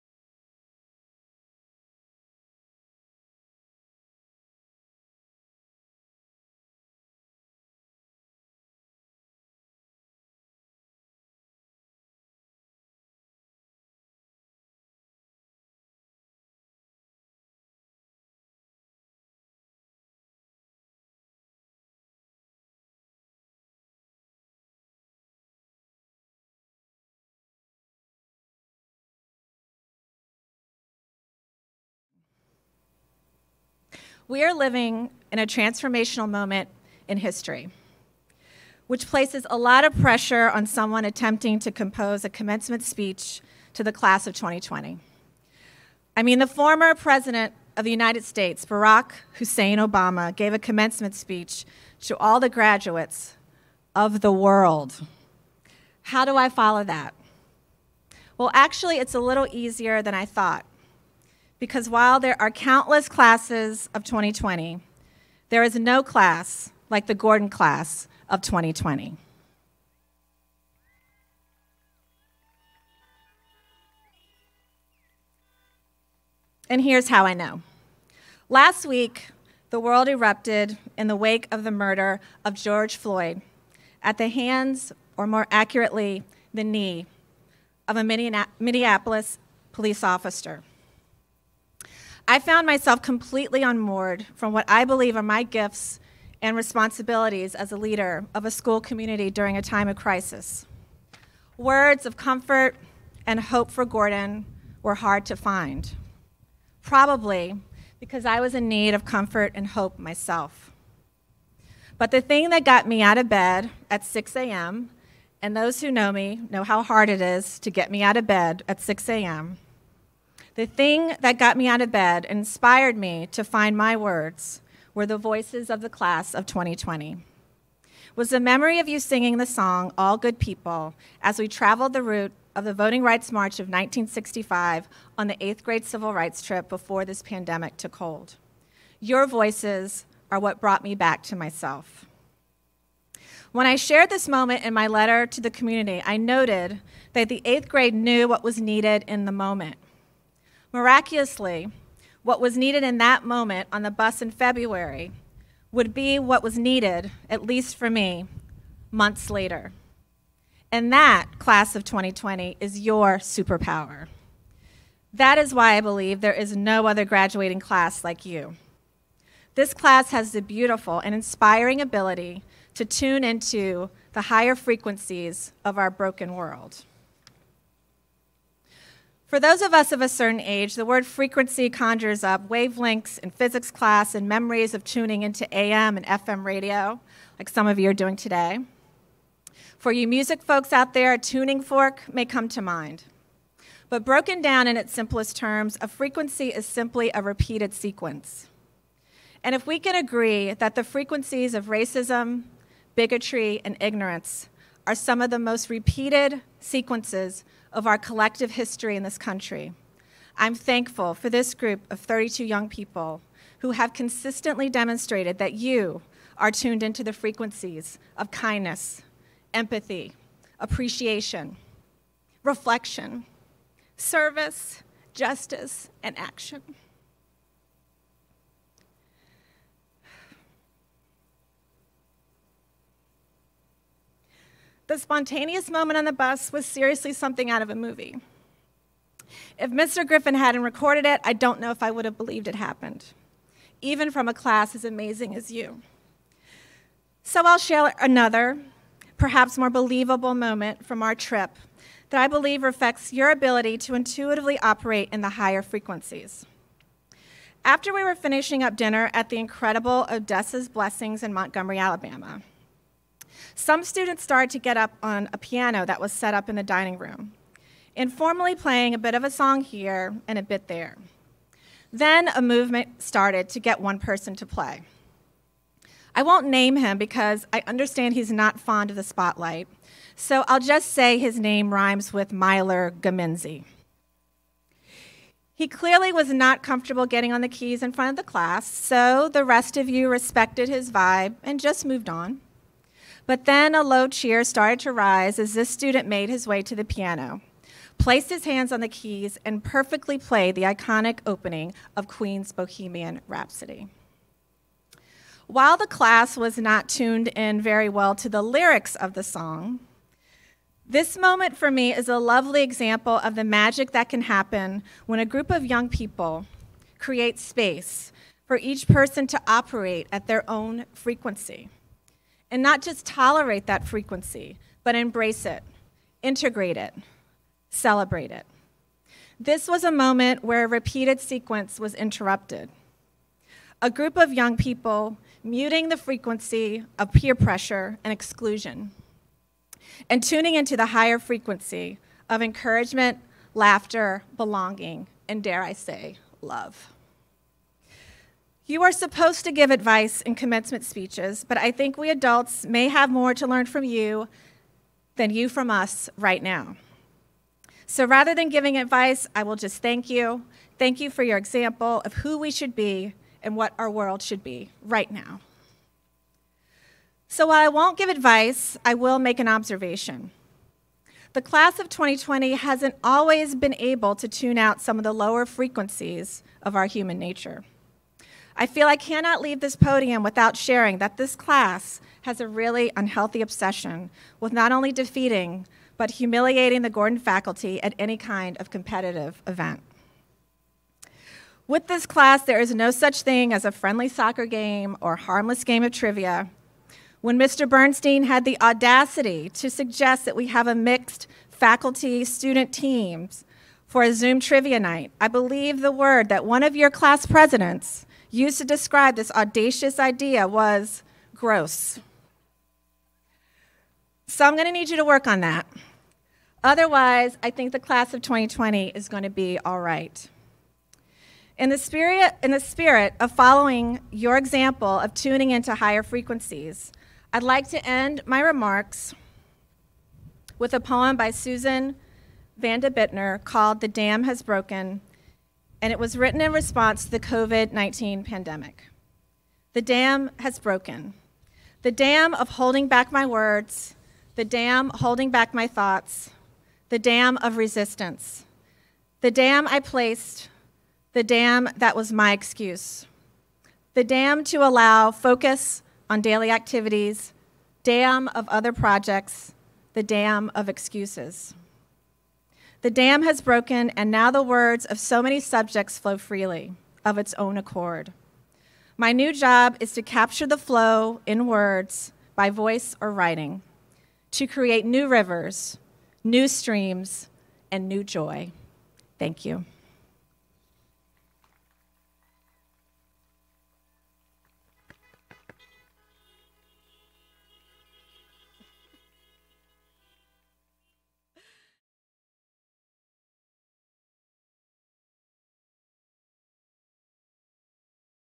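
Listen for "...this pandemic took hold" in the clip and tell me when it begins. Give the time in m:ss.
2:17.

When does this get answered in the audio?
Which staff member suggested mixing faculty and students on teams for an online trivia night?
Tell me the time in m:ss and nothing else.
6:37.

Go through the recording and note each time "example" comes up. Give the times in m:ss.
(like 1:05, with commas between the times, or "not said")
5:12, 6:01, 7:04.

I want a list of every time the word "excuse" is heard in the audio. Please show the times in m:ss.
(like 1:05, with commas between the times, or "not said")
7:32, 7:40.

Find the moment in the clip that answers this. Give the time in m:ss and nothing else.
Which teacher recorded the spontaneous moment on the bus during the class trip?
3:59.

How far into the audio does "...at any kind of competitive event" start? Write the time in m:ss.
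6:27.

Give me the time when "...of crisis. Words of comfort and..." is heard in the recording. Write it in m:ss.
1:39.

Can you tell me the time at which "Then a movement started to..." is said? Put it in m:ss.
4:31.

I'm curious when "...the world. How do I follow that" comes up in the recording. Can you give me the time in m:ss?
0:54.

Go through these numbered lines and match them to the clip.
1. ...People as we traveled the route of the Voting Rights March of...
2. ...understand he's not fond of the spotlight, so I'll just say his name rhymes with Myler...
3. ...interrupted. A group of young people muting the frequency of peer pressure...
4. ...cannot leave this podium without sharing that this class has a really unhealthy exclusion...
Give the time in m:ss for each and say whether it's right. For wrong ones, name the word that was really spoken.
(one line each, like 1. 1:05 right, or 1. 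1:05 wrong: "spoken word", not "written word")
1. 2:10 right
2. 4:37 right
3. 5:31 right
4. 6:18 wrong: "obsession", not "exclusion".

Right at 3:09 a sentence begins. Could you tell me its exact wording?
For you music folks out there, a tuning fork may come to mind.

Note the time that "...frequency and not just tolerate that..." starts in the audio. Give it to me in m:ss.
5:20.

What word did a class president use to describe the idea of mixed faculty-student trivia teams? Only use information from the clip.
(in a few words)
gross.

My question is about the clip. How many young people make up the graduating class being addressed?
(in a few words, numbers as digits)
32.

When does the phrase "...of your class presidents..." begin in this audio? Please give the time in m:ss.
6:46.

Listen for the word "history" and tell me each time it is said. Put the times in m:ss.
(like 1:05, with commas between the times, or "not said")
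0:37, 3:28.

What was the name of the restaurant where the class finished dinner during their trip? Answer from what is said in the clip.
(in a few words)
Odessa's Blessings.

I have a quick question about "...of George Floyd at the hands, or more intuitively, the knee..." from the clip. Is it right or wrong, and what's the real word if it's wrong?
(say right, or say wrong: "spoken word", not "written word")
wrong: "accurately", not "intuitively".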